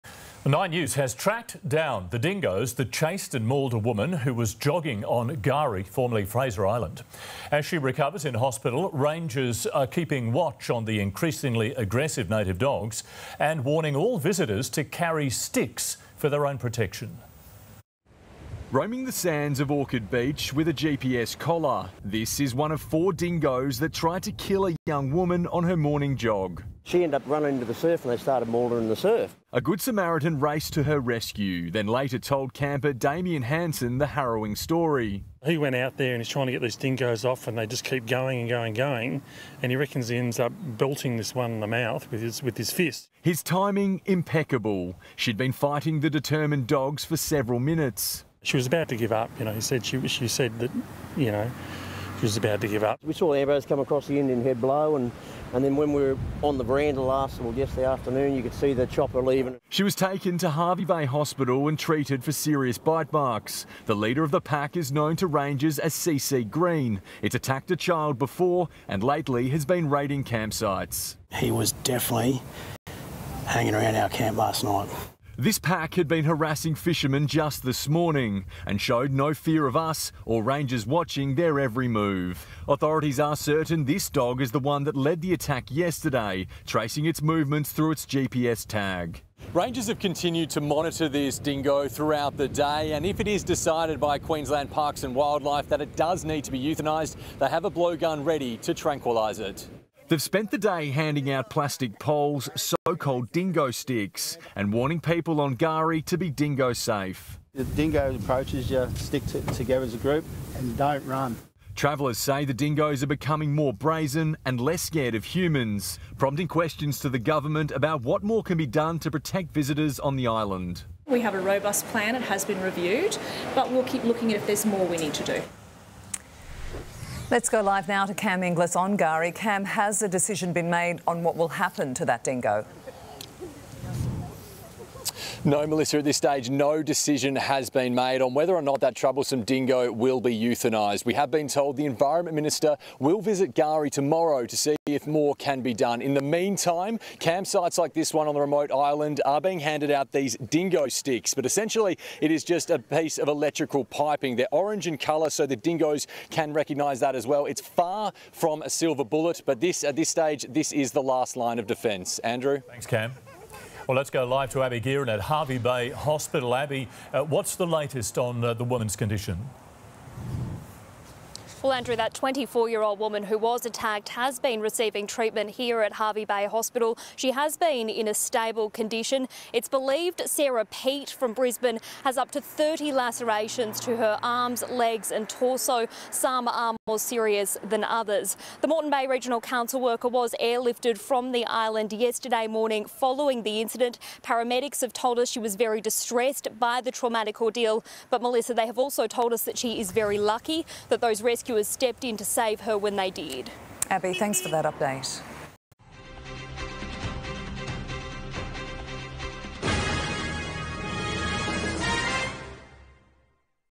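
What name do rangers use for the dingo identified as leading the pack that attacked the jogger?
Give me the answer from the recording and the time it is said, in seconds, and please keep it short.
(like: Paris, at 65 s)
CC Green, at 65 s.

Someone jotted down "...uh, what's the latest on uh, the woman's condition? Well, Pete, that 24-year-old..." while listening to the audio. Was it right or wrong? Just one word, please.
wrong.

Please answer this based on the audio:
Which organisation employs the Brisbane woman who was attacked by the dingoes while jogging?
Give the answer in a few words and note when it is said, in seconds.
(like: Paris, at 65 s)
Moreton Bay Regional Council, at 188 s.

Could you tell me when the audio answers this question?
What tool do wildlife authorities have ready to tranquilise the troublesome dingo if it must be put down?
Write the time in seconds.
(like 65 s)
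97 s.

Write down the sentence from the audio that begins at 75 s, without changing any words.
This pack had been harassing fishermen just this morning and showed no fear of us or rangers watching their every move.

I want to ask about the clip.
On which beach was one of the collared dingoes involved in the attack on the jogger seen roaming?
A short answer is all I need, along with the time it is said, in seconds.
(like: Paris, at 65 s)
Orchid Beach, at 19 s.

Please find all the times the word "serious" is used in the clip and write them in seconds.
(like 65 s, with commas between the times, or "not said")
62 s, 186 s.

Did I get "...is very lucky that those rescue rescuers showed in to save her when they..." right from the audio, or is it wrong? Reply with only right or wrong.
wrong.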